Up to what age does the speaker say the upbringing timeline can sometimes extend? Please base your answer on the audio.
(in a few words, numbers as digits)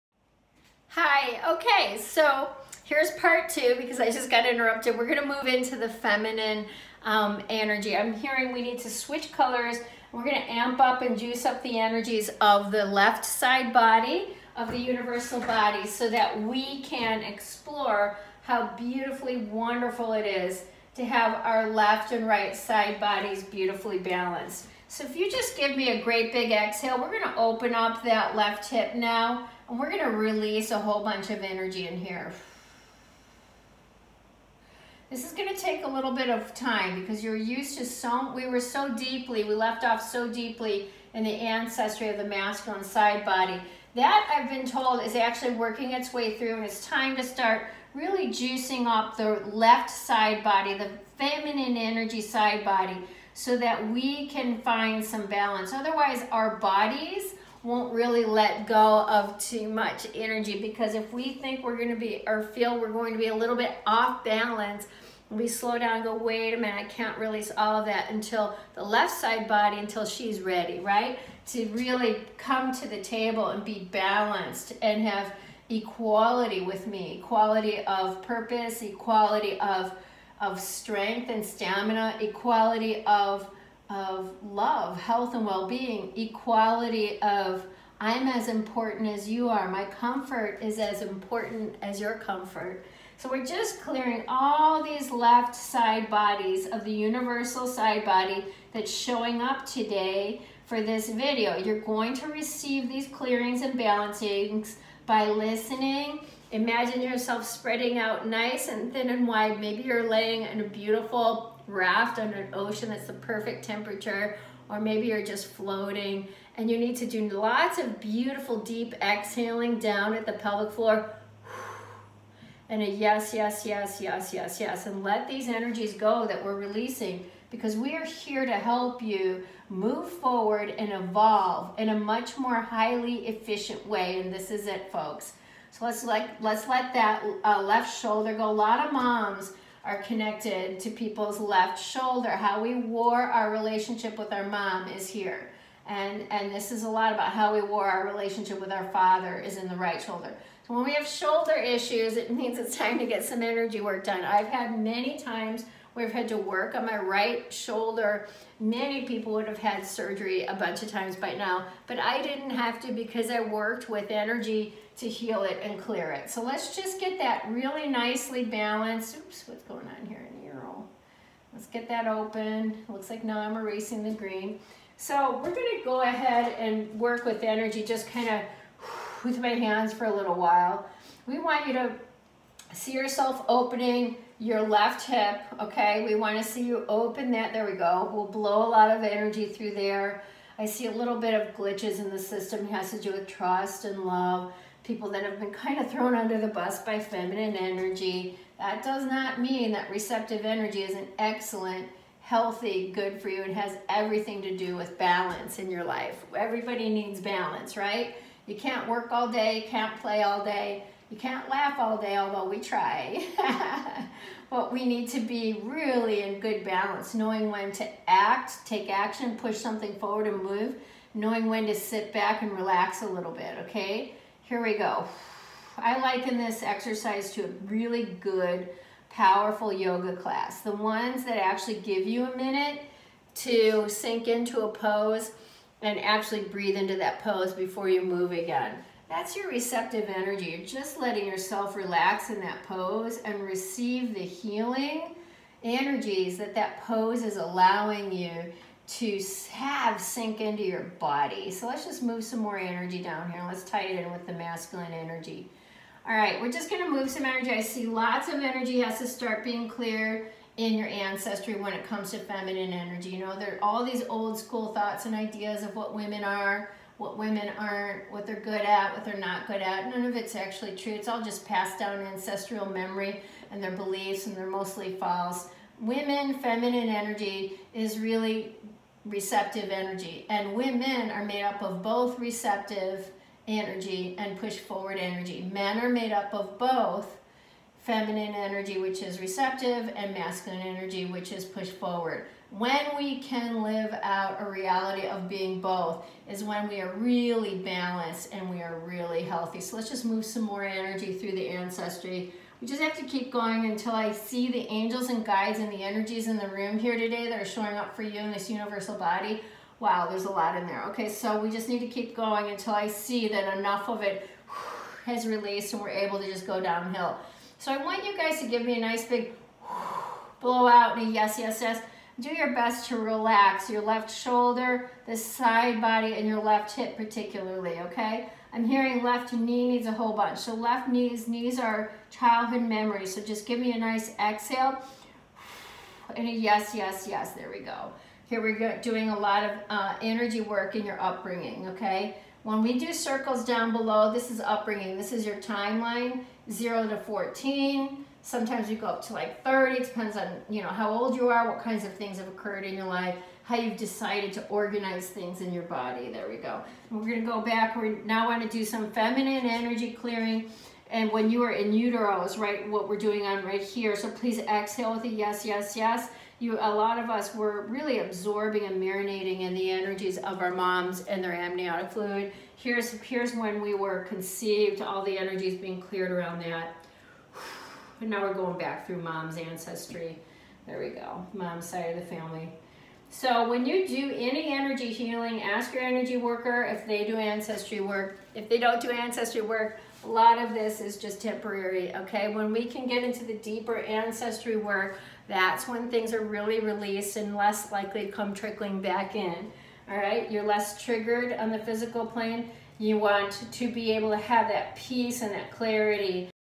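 30.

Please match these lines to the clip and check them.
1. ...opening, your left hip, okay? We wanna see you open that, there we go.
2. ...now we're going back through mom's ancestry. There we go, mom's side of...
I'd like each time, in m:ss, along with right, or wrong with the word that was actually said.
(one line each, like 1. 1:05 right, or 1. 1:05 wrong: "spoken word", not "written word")
1. 3:03 right
2. 6:18 right.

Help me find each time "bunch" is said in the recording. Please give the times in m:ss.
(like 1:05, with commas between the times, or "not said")
0:31, 2:40, 5:30.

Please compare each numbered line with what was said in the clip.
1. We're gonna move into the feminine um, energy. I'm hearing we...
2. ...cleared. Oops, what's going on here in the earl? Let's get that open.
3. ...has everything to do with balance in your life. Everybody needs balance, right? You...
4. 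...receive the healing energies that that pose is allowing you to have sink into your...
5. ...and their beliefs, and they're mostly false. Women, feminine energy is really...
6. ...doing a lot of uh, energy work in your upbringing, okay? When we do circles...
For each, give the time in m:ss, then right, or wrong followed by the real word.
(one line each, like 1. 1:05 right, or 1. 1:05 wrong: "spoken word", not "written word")
1. 0:04 right
2. 2:48 wrong: "balanced", not "cleared"
3. 3:23 right
4. 4:03 right
5. 4:33 right
6. 5:38 right.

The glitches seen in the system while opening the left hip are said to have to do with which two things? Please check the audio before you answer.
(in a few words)
Trust and love.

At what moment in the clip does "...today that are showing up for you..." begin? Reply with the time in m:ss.
5:06.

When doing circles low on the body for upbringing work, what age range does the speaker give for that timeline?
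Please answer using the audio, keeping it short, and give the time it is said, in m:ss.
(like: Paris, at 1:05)
0 to 14, at 5:46.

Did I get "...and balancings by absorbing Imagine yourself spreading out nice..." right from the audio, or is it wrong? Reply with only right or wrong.
wrong.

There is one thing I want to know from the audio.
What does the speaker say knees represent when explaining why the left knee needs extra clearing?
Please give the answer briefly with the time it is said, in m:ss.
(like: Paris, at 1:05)
Childhood memories, at 5:32.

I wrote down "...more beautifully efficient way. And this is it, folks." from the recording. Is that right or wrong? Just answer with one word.
wrong.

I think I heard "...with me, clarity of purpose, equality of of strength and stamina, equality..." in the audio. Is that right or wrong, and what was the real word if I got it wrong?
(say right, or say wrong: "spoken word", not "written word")
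wrong: "equality", not "clarity".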